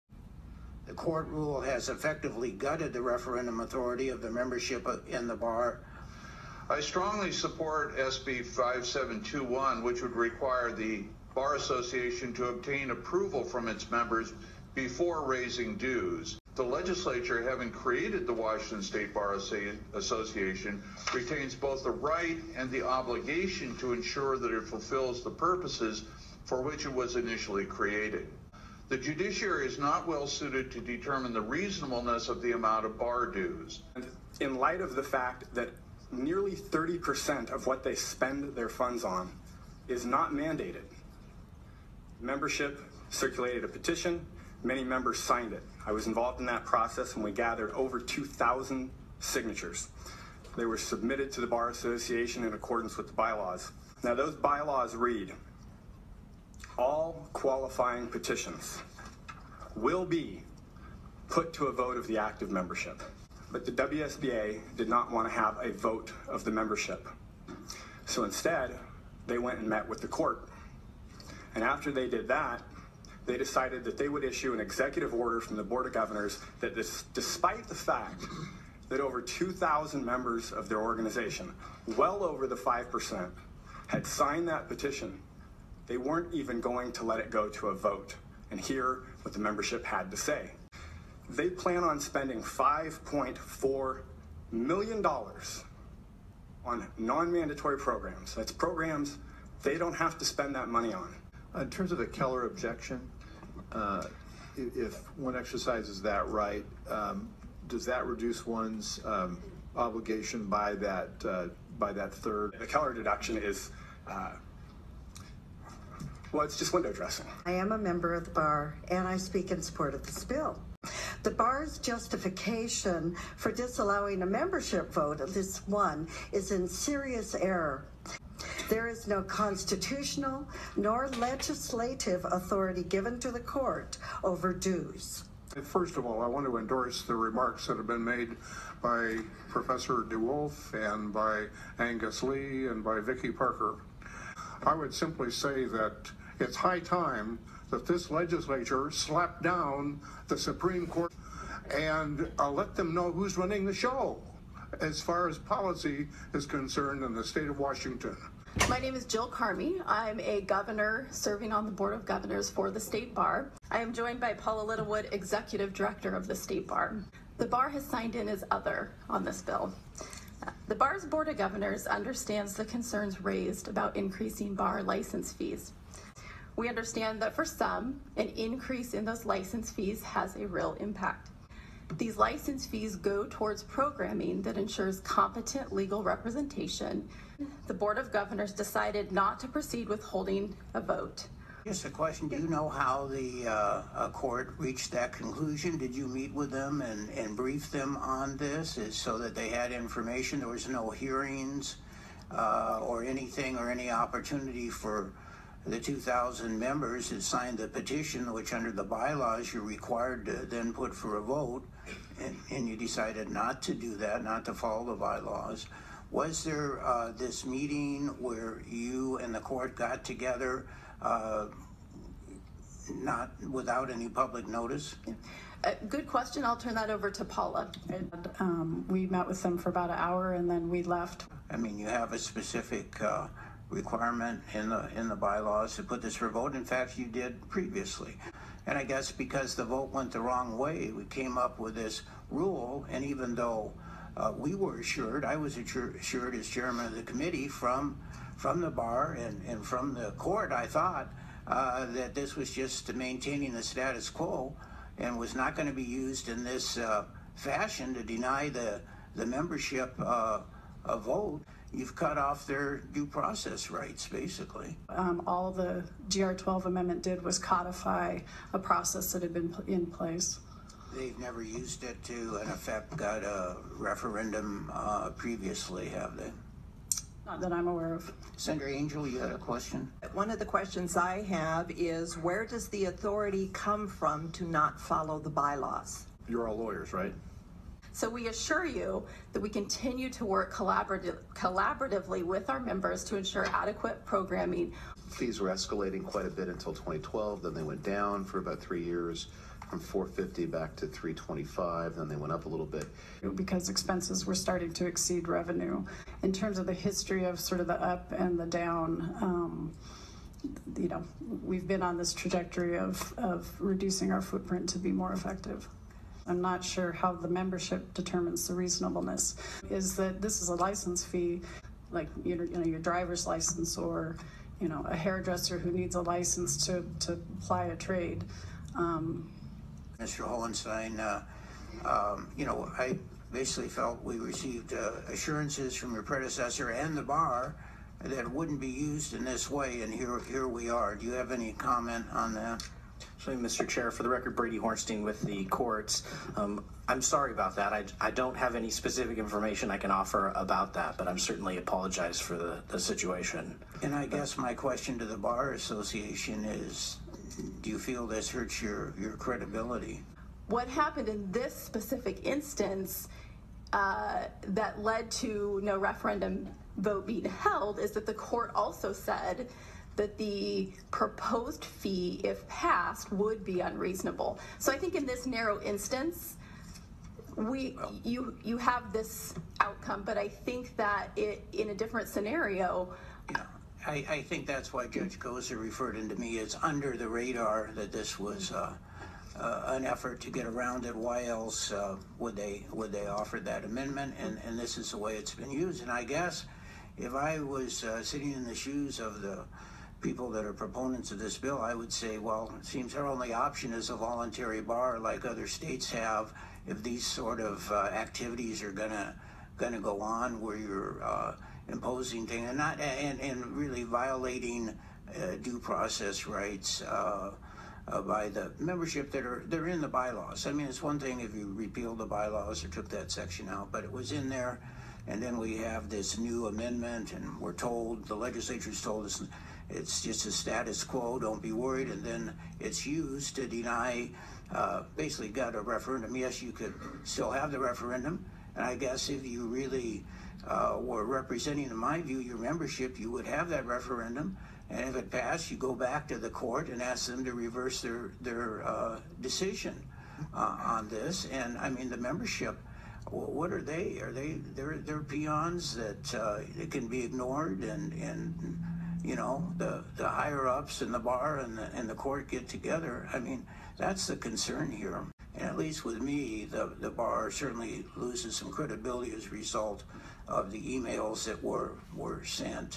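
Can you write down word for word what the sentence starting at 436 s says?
Yes, you could still have the referendum.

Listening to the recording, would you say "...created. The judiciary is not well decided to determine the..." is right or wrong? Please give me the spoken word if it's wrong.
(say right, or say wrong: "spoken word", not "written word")
wrong: "suited", not "decided".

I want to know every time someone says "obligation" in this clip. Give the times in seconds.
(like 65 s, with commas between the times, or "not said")
22 s, 109 s.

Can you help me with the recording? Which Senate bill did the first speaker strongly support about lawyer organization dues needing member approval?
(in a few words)
SB 5721.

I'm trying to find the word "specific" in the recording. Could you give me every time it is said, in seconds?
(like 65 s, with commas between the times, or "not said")
232 s, 348 s, 361 s.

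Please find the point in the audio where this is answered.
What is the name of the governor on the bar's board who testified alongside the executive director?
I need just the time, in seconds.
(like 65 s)
159 s.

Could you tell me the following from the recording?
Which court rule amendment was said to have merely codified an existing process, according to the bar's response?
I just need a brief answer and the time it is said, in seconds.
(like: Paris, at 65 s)
GR 12, at 266 s.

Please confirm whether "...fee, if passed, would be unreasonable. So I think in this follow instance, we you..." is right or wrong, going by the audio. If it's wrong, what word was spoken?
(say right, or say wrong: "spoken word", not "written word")
wrong: "narrow", not "follow".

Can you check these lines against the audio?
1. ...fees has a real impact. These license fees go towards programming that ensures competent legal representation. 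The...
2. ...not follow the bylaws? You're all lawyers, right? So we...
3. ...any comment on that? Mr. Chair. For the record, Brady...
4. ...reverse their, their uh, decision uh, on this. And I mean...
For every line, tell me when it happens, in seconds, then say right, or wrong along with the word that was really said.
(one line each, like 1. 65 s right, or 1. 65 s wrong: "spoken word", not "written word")
1. 179 s right
2. 284 s right
3. 341 s right
4. 447 s right.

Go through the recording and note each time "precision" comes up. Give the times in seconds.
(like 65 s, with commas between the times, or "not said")
not said.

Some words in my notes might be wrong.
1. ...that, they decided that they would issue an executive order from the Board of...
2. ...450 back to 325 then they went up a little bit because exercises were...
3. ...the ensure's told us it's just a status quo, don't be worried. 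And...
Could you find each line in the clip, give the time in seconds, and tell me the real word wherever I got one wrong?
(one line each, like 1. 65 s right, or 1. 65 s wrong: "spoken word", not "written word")
1. 72 s right
2. 299 s wrong: "expenses", not "exercises"
3. 428 s wrong: "legislature", not "ensure".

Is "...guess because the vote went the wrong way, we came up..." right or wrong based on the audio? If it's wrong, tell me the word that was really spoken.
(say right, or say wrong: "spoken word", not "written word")
right.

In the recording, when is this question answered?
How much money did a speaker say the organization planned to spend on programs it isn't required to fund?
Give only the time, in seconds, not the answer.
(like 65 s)
92 s.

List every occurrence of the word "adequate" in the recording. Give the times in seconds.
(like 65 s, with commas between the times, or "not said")
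293 s.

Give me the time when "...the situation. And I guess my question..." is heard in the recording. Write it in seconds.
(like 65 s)
352 s.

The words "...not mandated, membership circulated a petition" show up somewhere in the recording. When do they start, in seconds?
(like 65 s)
40 s.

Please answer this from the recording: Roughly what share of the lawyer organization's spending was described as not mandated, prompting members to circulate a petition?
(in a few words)
30%.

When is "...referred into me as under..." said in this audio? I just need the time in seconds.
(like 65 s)
385 s.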